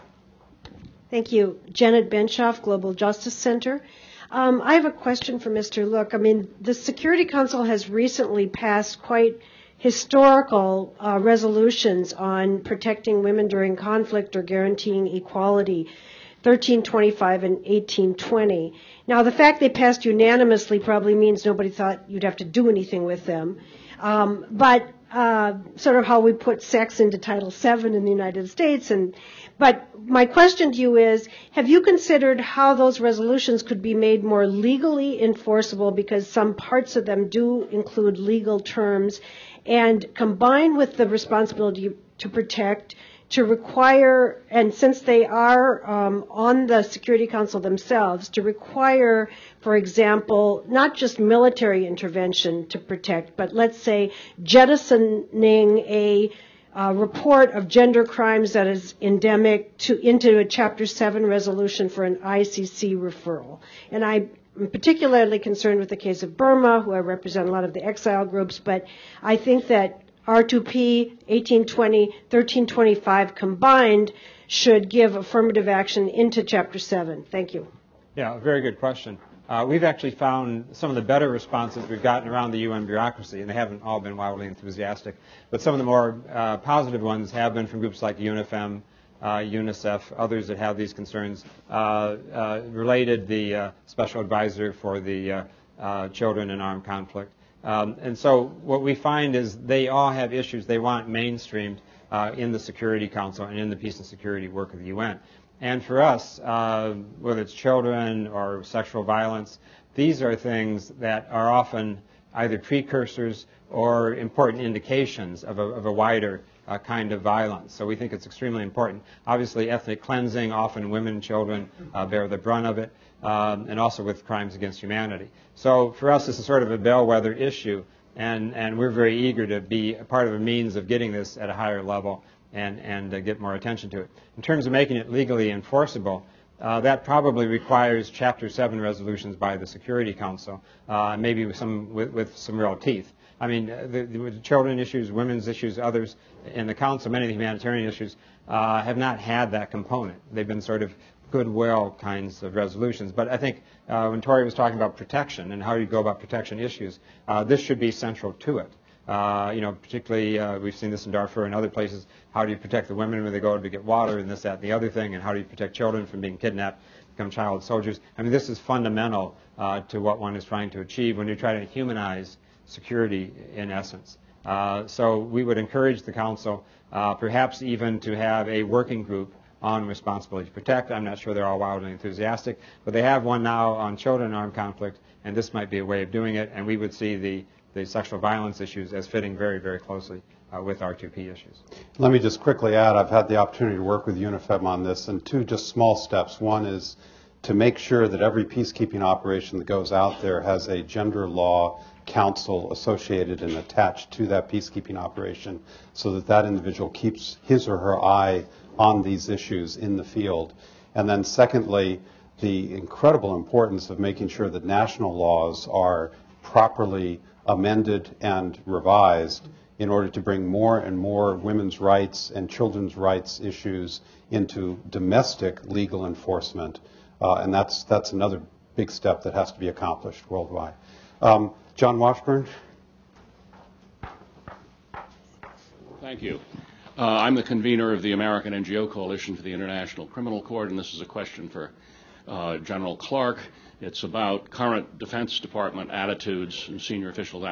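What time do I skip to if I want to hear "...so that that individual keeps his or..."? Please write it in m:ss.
3:25.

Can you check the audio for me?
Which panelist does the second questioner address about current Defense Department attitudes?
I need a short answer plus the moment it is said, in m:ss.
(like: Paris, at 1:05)
General Clark, at 4:02.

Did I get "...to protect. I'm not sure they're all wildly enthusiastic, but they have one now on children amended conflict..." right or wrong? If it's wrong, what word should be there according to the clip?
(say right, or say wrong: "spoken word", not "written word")
wrong: "armed", not "amended".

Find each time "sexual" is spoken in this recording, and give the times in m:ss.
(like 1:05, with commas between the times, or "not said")
1:48, 3:07.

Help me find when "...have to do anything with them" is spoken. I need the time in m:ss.
0:22.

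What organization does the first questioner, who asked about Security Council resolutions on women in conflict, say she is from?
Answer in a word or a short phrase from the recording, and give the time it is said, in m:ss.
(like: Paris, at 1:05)
Global Justice Center, at 0:02.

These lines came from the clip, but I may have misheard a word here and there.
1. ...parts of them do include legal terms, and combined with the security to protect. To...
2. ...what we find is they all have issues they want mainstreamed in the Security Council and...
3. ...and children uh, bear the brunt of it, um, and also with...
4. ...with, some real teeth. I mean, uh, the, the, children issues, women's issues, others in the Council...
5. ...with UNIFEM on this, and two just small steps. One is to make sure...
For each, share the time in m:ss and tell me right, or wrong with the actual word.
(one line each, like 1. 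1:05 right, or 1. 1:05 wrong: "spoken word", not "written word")
1. 0:36 wrong: "responsibility", not "security"
2. 1:38 right
3. 2:01 right
4. 2:22 right
5. 3:14 right.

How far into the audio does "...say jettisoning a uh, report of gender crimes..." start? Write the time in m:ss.
0:53.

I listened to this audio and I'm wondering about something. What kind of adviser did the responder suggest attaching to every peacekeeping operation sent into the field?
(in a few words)
gender law council.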